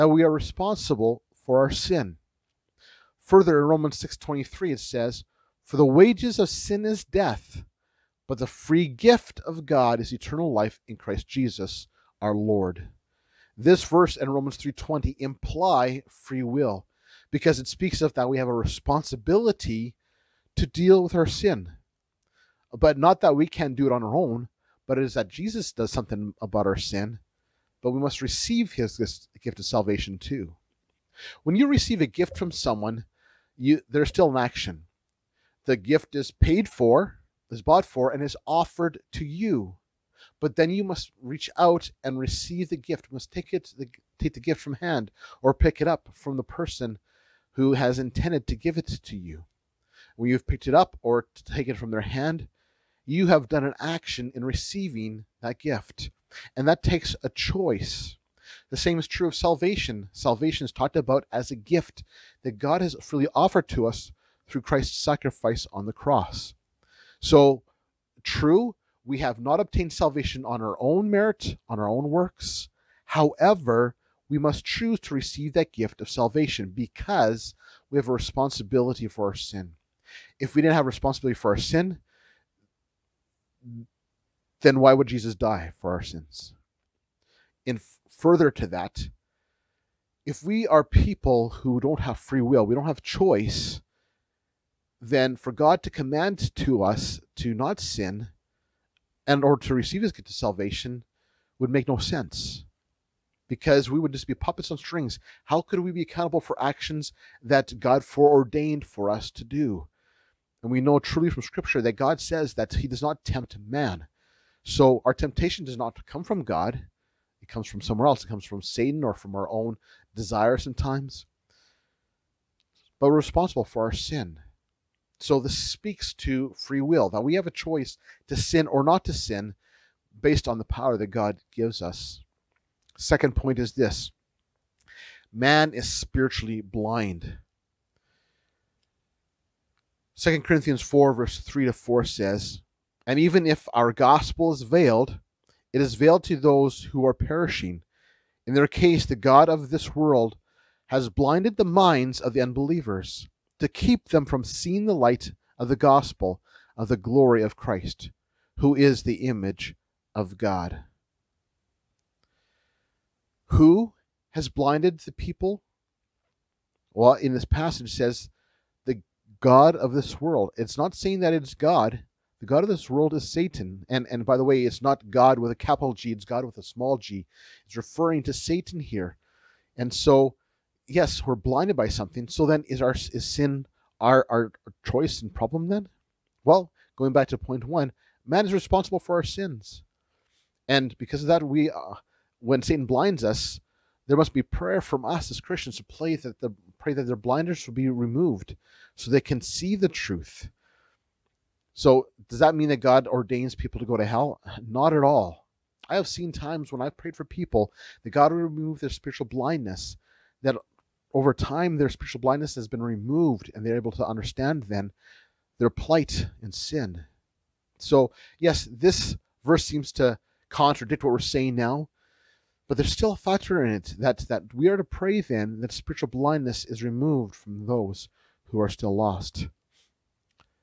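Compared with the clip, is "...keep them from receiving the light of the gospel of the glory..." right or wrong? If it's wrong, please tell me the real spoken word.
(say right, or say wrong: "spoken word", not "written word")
wrong: "seeing", not "receiving".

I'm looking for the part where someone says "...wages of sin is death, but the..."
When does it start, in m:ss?
0:05.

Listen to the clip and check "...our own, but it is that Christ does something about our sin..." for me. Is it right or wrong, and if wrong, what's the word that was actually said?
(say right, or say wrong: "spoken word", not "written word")
wrong: "Jesus", not "Christ".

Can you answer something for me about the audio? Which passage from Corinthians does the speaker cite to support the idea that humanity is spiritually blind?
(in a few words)
2 Corinthians 4:3-4.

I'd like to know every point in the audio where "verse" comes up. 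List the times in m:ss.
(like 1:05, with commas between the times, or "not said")
0:13, 2:21, 3:39.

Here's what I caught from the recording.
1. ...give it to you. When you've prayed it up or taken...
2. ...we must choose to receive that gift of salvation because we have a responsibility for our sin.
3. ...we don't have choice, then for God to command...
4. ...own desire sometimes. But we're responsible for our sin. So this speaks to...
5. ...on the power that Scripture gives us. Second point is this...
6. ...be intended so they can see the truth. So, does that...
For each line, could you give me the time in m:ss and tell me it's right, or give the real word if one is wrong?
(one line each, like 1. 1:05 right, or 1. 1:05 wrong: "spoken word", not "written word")
1. 0:48 wrong: "picked", not "prayed"
2. 1:14 right
3. 1:32 right
4. 1:59 right
5. 2:10 wrong: "God", not "Scripture"
6. 3:17 wrong: "removed", not "intended".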